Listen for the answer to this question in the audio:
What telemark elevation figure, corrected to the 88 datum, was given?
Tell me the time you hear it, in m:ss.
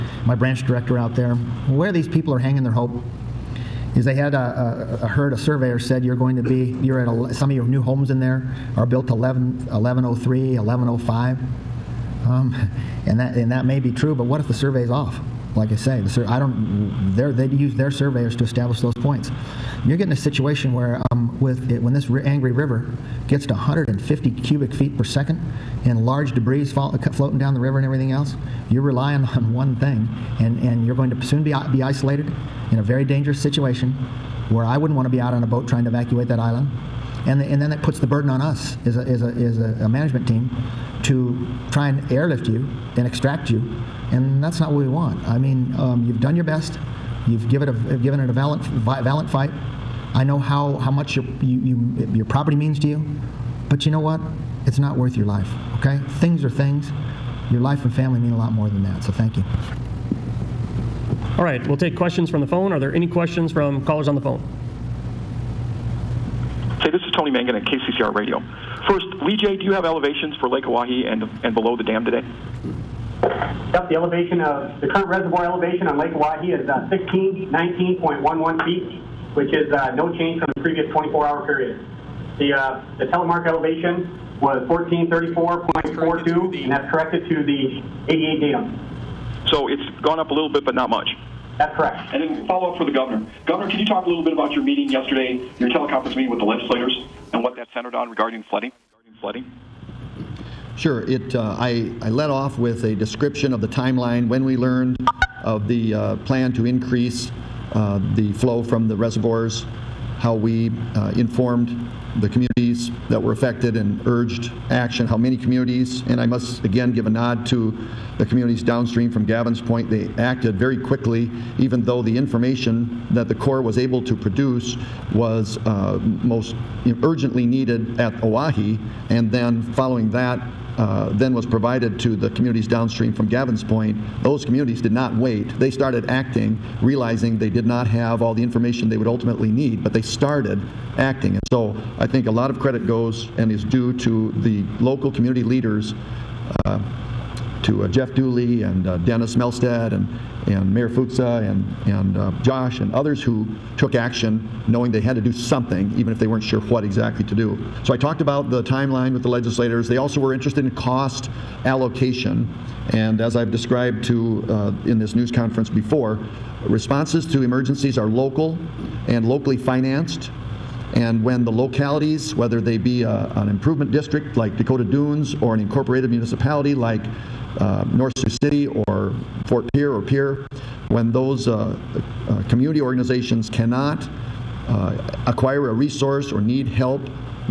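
1:24.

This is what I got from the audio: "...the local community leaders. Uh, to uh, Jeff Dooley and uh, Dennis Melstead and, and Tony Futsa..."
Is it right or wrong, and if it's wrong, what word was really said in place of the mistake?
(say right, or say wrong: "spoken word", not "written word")
wrong: "Mayor", not "Tony".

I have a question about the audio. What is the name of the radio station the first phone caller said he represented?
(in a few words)
KCCR Radio.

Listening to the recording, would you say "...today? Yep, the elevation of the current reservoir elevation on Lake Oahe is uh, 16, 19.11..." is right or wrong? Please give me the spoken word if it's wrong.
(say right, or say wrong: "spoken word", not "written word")
right.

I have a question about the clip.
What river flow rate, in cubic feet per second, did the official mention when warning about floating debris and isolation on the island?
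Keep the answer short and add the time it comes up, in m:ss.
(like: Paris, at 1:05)
150, at 0:23.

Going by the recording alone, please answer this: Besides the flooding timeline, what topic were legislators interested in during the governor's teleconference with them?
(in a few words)
Cost allocation.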